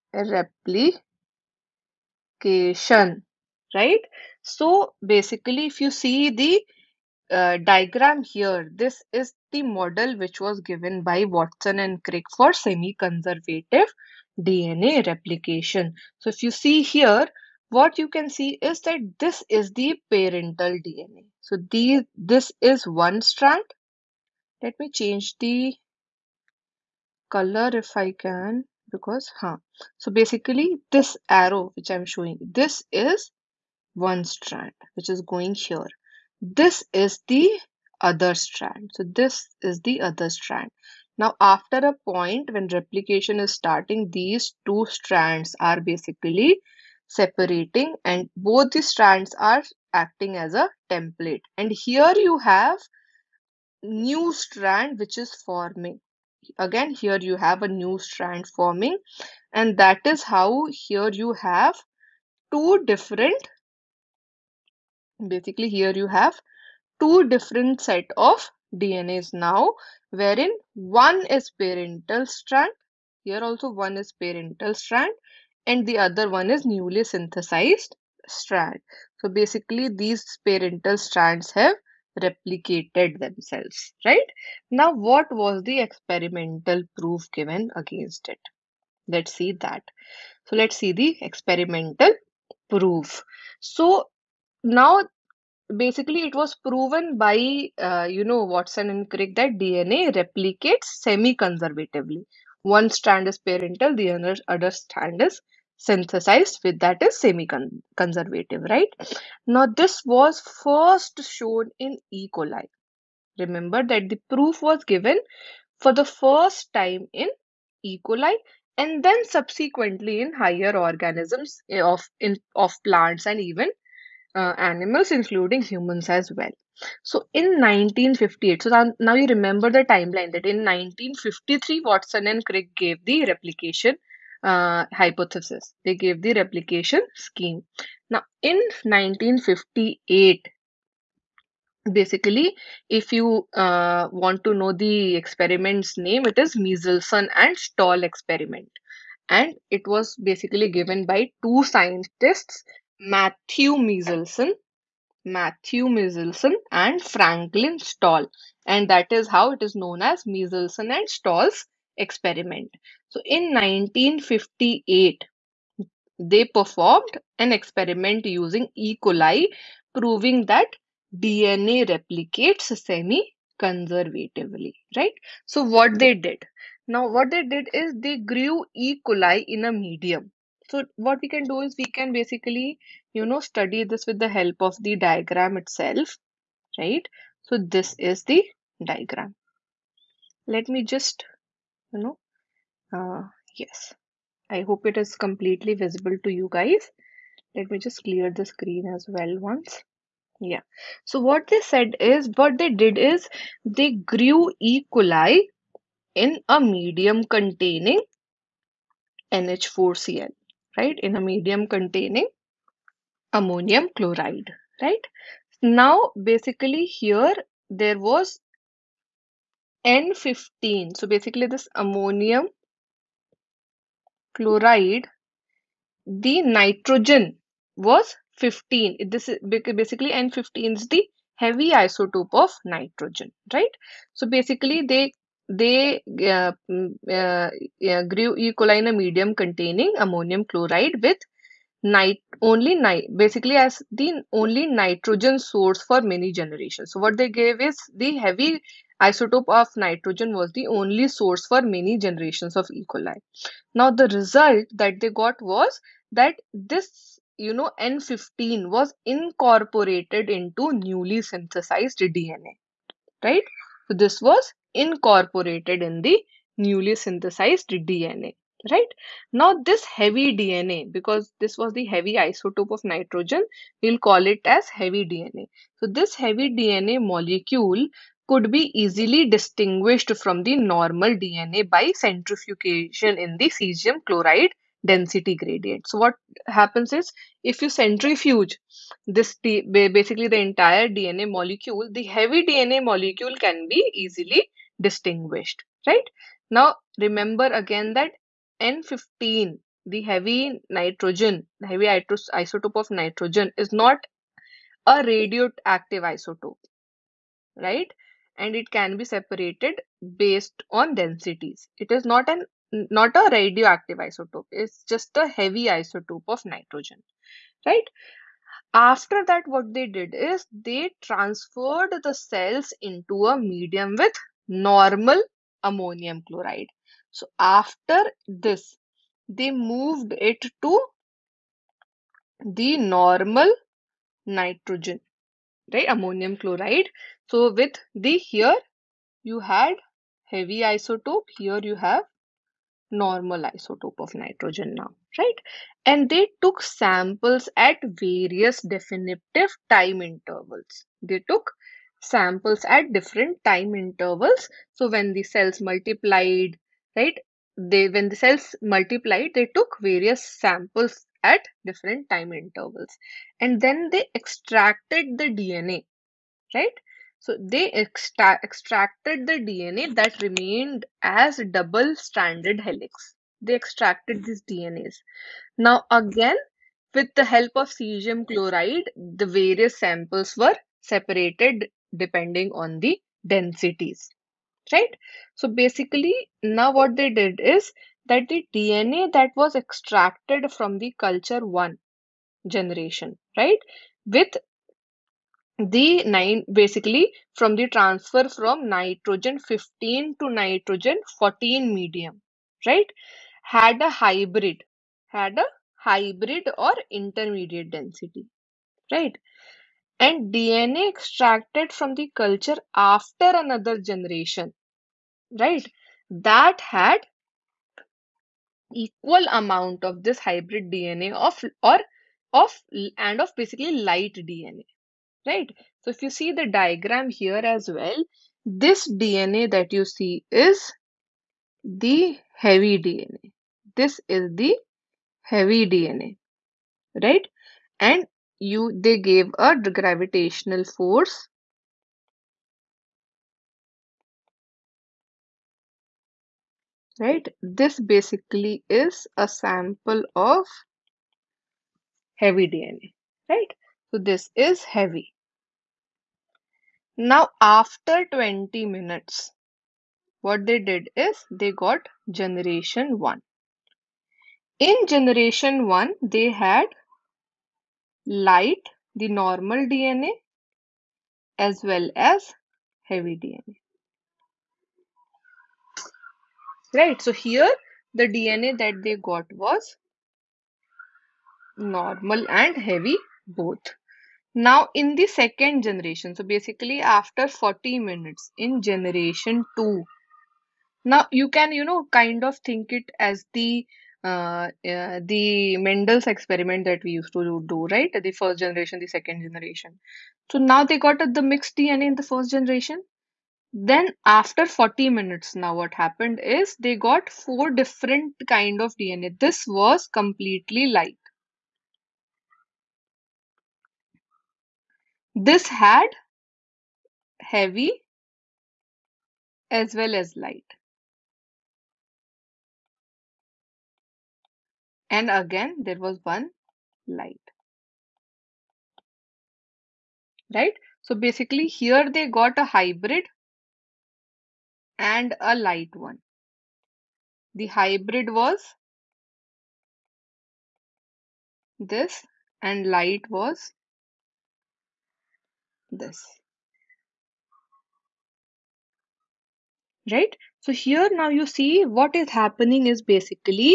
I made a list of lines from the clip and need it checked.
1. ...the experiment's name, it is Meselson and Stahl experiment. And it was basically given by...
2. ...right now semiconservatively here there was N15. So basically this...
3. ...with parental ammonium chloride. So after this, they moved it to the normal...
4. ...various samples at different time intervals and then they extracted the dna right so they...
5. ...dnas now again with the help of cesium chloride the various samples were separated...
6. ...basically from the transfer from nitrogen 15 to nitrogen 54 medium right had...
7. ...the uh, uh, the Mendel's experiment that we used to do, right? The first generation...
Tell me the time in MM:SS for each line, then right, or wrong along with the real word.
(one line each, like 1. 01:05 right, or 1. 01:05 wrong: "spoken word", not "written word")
1. 02:24 right
2. 03:34 wrong: "basically", not "semiconservatively"
3. 05:23 wrong: "normal", not "parental"
4. 05:59 right
5. 06:14 right
6. 06:36 wrong: "14", not "54"
7. 08:13 right.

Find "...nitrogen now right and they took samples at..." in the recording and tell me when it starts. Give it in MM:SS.
05:44.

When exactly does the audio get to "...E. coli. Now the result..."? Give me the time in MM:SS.
04:12.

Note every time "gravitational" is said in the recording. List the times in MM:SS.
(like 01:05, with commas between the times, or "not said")
07:19.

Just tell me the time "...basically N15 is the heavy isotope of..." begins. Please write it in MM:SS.
03:49.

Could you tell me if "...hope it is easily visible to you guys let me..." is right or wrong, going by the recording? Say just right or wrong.
wrong.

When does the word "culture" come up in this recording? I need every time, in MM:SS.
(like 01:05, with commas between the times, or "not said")
06:30, 06:52.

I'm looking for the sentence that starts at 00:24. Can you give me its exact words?
Let me change the color if I can because huh.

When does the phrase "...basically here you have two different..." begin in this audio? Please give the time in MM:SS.
01:05.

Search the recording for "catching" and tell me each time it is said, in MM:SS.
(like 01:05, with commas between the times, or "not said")
not said.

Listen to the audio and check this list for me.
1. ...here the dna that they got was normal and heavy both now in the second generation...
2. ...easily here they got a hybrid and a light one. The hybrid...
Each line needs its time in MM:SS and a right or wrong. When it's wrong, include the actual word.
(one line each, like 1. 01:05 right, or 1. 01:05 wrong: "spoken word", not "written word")
1. 07:57 right
2. 08:50 wrong: "basically", not "easily".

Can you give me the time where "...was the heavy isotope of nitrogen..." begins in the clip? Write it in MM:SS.
04:31.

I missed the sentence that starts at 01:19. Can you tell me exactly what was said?
So basically these parental strands have replicated themselves, right?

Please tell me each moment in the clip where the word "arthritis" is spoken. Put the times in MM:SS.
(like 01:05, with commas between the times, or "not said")
not said.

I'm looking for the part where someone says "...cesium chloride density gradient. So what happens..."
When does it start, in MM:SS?
04:43.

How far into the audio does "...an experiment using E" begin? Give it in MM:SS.
02:47.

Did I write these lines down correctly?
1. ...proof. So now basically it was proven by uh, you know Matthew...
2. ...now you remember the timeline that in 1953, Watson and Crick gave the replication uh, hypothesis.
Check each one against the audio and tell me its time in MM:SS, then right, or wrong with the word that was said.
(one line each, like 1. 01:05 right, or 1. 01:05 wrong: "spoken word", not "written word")
1. 01:32 wrong: "Watson", not "Matthew"
2. 02:08 right.